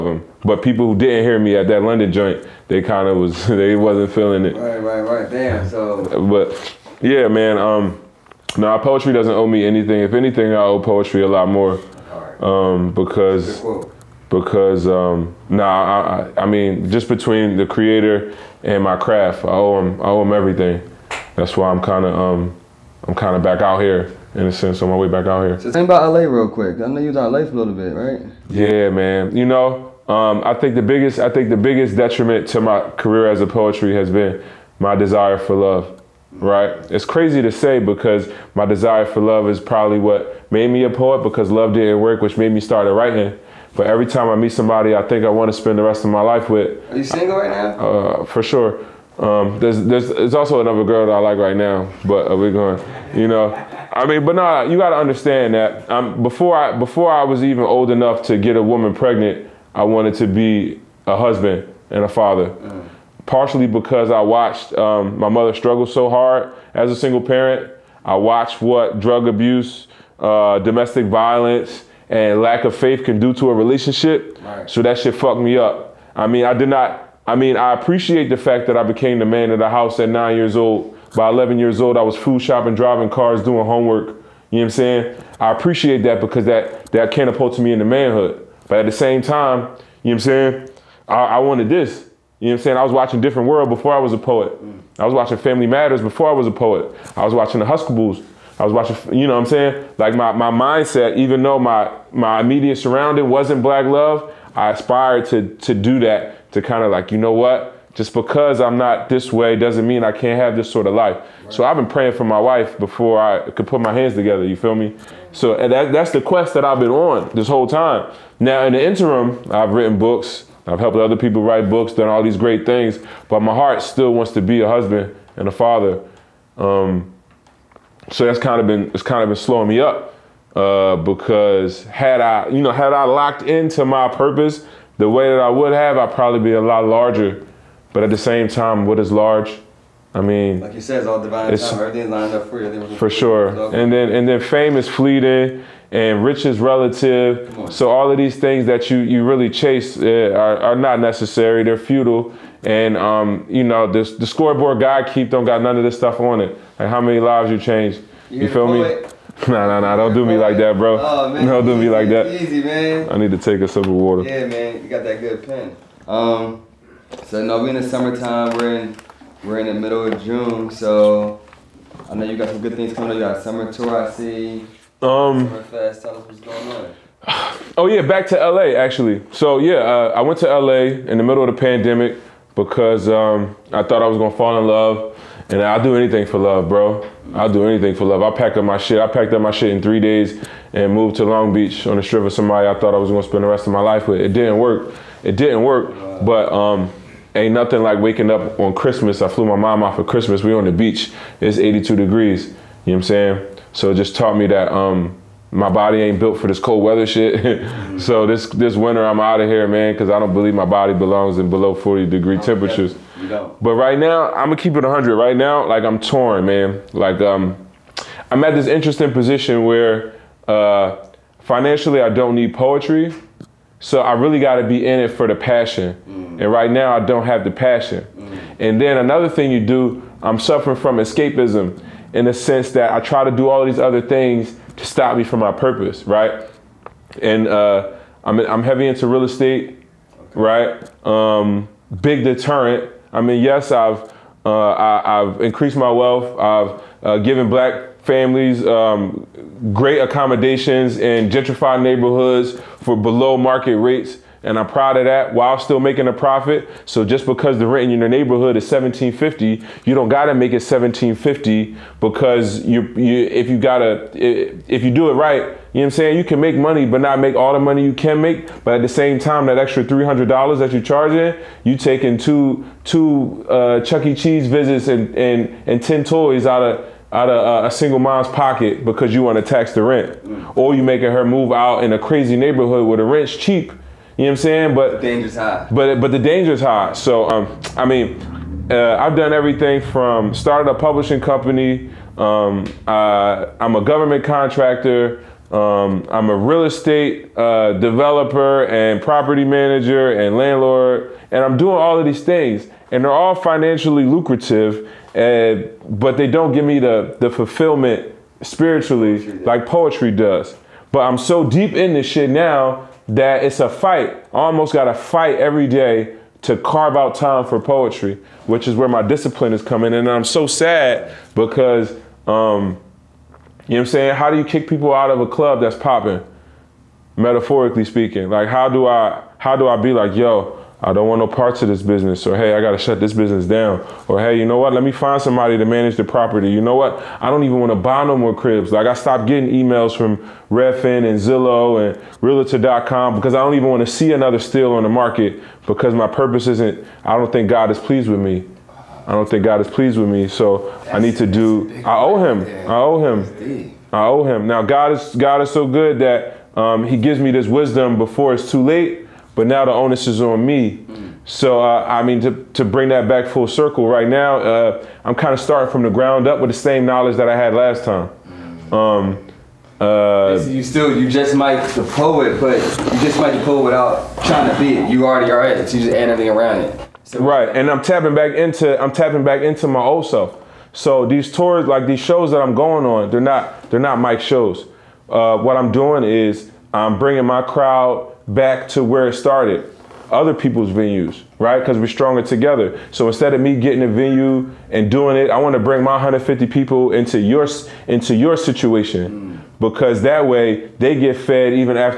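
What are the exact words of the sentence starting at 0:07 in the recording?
Um, no, poetry doesn't owe me anything.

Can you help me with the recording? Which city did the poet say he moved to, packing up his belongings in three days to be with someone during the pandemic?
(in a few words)
Long Beach.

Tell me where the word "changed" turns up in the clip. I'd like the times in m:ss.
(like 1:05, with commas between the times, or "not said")
2:37.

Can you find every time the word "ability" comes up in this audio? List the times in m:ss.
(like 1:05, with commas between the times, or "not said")
not said.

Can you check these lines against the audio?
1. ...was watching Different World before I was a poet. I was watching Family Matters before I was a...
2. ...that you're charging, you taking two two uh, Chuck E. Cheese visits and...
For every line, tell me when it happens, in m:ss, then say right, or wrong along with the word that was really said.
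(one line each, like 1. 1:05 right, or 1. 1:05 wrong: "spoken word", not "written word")
1. 1:32 right
2. 4:30 right.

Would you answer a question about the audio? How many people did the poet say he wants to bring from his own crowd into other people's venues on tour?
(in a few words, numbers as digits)
150.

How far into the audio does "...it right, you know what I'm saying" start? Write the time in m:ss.
4:25.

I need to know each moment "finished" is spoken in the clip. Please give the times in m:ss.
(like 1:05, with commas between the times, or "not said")
not said.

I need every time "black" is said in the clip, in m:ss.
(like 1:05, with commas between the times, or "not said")
1:43, 4:07.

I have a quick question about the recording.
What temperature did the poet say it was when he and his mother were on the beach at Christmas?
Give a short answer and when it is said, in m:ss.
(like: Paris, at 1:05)
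82 degrees, at 3:21.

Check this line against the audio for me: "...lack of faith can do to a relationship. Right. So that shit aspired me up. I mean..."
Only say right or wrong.
wrong.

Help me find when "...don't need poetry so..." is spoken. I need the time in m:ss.
3:42.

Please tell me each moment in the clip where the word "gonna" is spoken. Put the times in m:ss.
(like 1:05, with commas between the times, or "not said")
3:04, 3:13, 3:34.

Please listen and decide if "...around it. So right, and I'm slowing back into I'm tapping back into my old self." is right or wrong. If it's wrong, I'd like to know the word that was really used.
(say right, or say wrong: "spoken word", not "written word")
wrong: "tapping", not "slowing".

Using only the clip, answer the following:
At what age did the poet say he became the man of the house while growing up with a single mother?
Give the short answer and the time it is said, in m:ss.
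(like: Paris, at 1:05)
9, at 1:20.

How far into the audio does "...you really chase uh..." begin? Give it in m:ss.
2:28.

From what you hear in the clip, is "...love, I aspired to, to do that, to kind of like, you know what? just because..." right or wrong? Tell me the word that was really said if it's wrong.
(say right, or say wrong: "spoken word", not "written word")
right.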